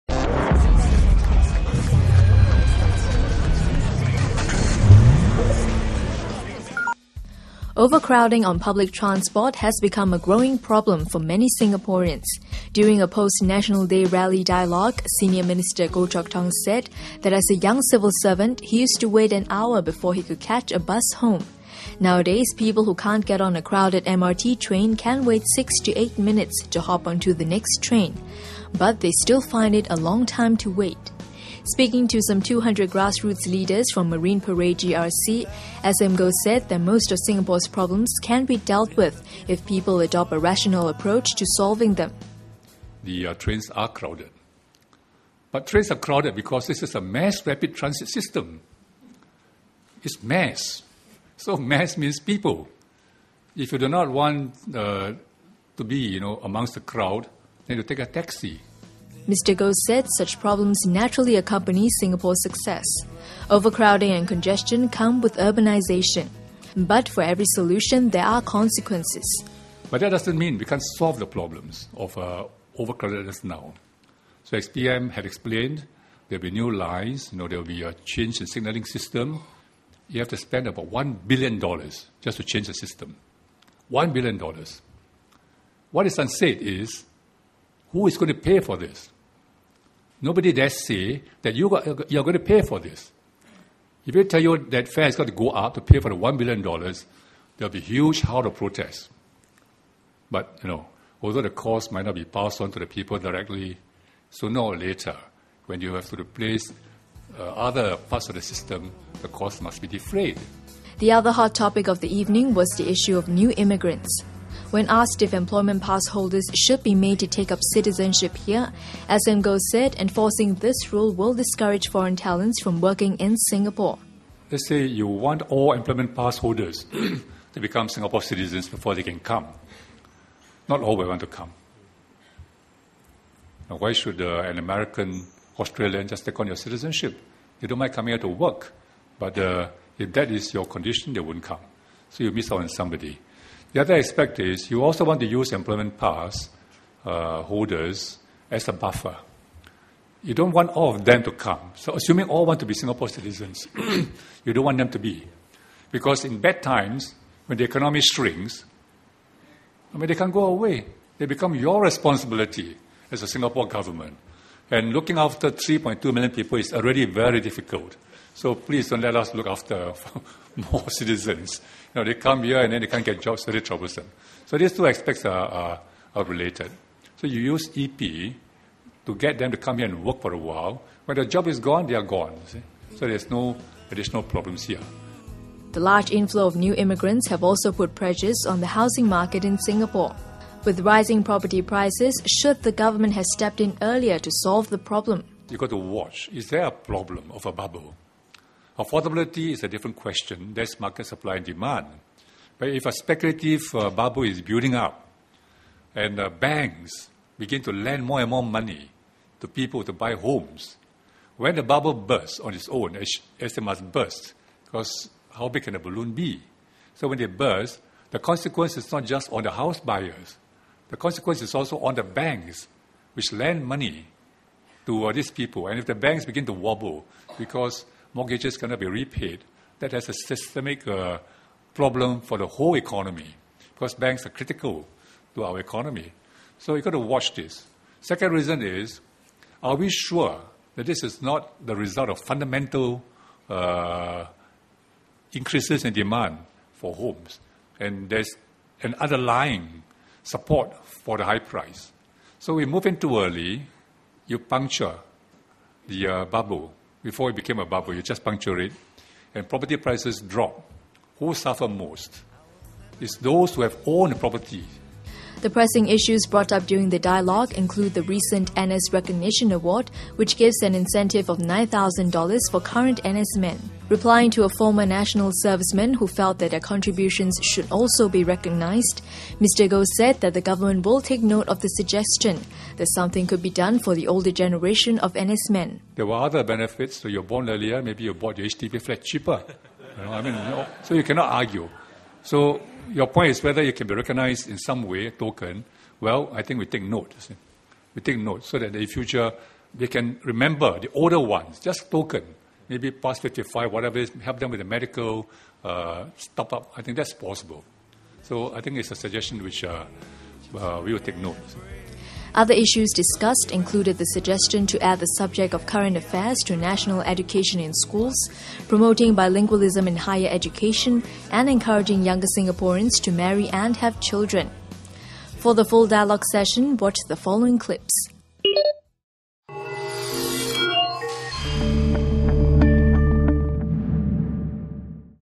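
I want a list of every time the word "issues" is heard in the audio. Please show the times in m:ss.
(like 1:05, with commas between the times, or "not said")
1:52, 4:25, 5:12.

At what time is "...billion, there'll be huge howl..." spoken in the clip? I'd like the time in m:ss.
1:36.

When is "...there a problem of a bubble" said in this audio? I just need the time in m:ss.
3:16.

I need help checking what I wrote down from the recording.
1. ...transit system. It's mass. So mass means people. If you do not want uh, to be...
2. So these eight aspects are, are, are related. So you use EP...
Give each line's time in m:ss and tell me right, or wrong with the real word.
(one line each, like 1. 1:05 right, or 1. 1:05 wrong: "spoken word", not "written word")
1. 0:47 right
2. 2:54 wrong: "two", not "eight".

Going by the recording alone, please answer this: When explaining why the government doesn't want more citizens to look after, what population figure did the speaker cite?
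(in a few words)
3.2 million.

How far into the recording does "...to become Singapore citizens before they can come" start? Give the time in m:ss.
2:07.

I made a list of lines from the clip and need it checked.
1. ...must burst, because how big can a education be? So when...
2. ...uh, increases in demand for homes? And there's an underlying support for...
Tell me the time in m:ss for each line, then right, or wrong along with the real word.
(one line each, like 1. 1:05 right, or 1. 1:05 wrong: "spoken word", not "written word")
1. 3:33 wrong: "balloon", not "education"
2. 4:03 right.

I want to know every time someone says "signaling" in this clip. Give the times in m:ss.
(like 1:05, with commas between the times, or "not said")
1:18.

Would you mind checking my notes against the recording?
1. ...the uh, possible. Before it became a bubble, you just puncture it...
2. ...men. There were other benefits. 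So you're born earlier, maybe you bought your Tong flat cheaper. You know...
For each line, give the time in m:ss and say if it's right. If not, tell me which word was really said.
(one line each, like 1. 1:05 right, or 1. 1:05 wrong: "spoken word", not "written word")
1. 4:15 wrong: "bubble", not "possible"
2. 4:45 wrong: "HDB", not "Tong".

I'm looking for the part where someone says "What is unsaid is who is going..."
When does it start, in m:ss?
1:25.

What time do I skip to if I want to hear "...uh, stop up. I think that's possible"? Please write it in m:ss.
5:05.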